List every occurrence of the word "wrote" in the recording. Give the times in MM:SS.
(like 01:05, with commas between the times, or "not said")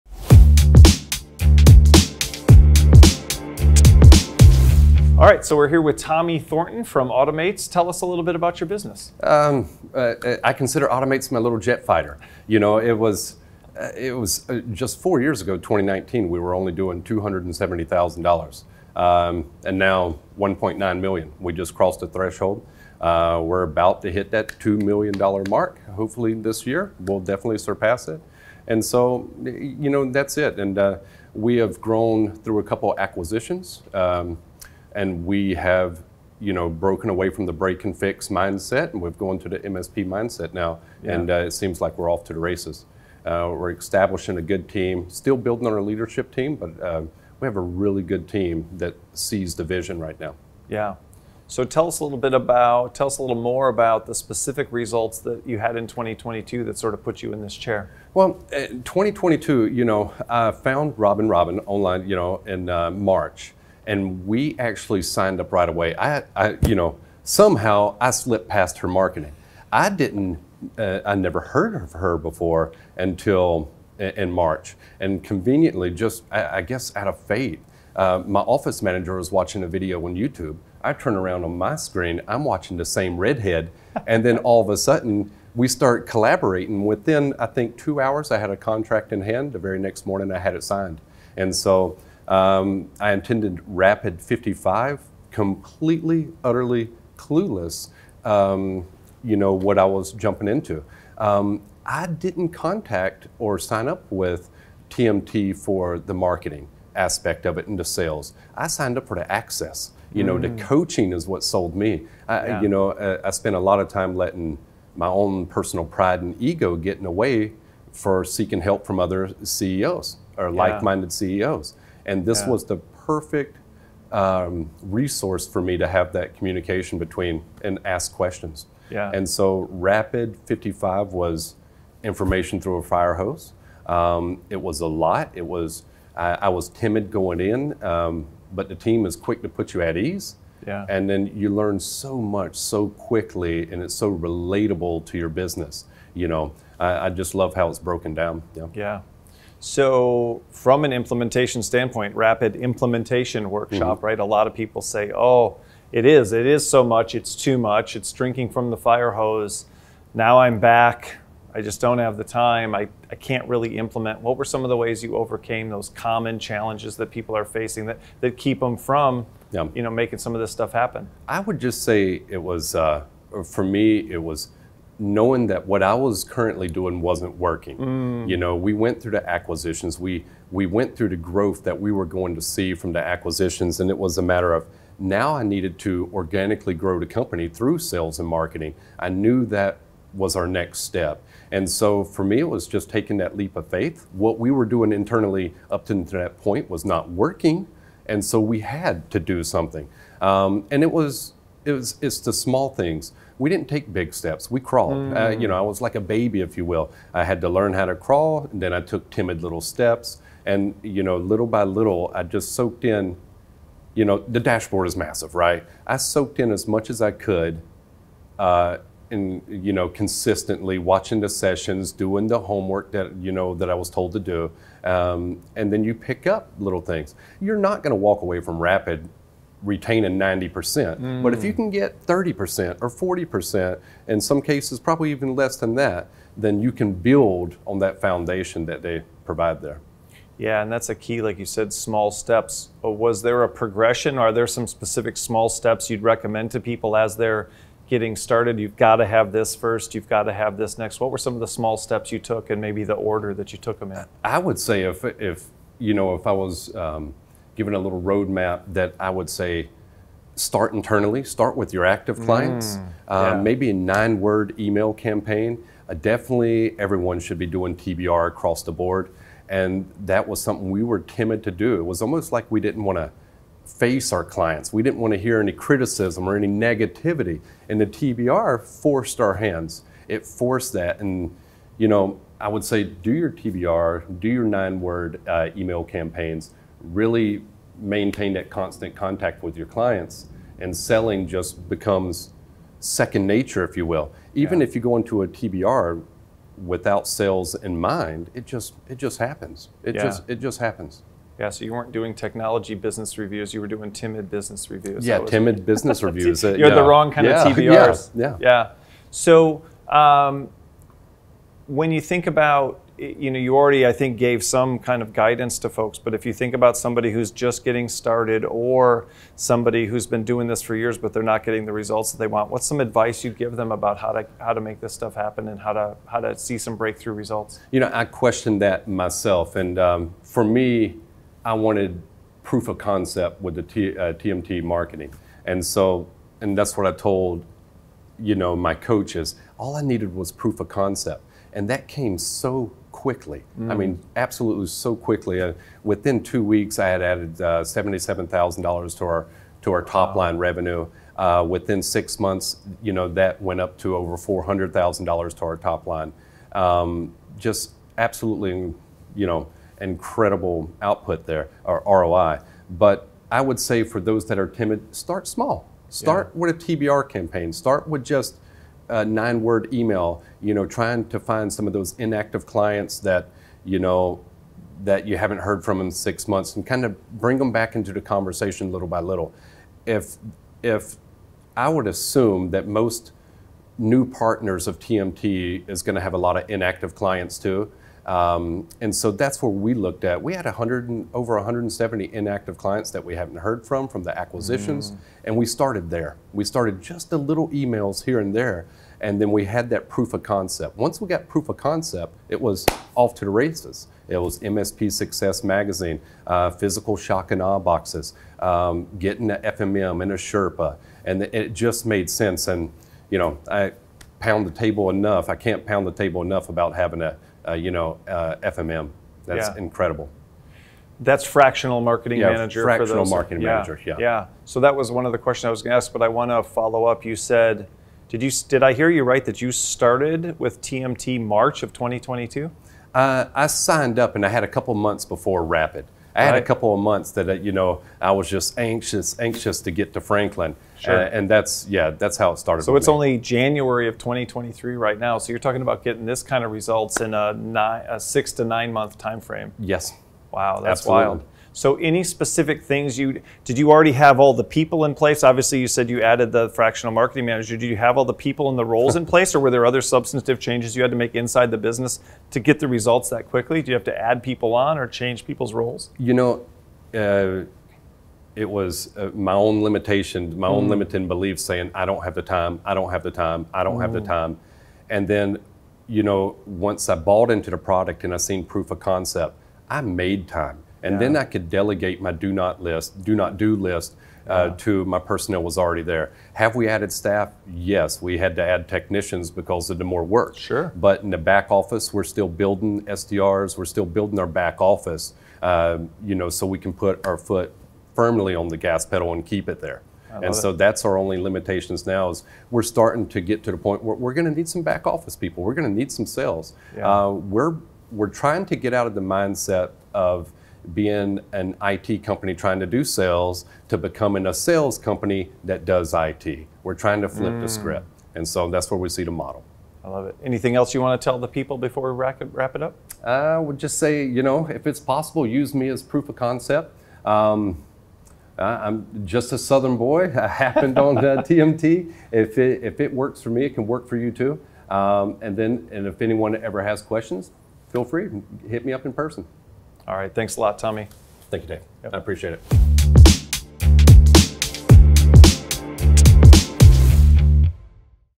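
not said.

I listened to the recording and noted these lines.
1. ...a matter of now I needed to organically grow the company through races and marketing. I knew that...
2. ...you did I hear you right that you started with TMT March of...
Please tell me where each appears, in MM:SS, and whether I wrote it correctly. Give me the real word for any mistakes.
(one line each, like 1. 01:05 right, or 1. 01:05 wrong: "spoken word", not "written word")
1. 03:04 wrong: "sales", not "races"
2. 07:08 right.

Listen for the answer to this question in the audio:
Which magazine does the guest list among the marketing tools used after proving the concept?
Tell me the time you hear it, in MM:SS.
06:44.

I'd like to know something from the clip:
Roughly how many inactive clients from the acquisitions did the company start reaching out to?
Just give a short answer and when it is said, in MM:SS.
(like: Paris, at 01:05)
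170, at 06:31.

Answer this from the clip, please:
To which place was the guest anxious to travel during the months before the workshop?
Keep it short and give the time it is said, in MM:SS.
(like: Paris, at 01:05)
Franklin, at 07:20.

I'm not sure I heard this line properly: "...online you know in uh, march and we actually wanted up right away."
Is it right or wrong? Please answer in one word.
wrong.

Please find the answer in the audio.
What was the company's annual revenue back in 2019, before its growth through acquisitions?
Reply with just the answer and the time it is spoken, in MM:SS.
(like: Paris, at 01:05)
$270,000, at 00:17.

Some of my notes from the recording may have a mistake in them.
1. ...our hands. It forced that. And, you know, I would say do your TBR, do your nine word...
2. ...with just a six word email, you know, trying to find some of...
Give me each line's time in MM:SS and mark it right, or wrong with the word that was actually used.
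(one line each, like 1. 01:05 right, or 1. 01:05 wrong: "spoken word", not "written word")
1. 04:39 right
2. 06:07 wrong: "nine", not "six".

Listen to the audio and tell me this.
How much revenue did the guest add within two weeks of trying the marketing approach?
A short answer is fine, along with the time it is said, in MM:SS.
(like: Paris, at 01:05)
$77,000, at 05:47.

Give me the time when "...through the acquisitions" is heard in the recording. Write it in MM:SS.
02:59.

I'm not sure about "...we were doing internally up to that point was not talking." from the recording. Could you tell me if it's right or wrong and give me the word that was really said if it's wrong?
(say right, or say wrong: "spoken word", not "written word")
wrong: "working", not "talking".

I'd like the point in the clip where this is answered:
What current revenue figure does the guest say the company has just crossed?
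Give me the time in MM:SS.
00:20.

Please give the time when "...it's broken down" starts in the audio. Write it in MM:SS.
02:27.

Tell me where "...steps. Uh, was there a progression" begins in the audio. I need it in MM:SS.
04:02.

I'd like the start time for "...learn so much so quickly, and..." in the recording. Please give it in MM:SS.
02:21.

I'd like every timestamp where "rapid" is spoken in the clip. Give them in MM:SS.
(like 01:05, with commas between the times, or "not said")
01:33, 02:09, 02:32, 03:48, 07:15.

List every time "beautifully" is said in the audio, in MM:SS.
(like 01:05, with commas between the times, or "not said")
not said.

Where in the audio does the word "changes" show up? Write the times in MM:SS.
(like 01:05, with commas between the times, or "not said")
07:40, 07:44.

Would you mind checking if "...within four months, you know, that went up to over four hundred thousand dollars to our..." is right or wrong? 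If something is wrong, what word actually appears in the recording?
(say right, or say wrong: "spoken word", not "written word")
wrong: "six", not "four".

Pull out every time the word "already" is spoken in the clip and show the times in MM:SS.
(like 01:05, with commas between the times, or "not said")
05:13, 07:33, 08:05.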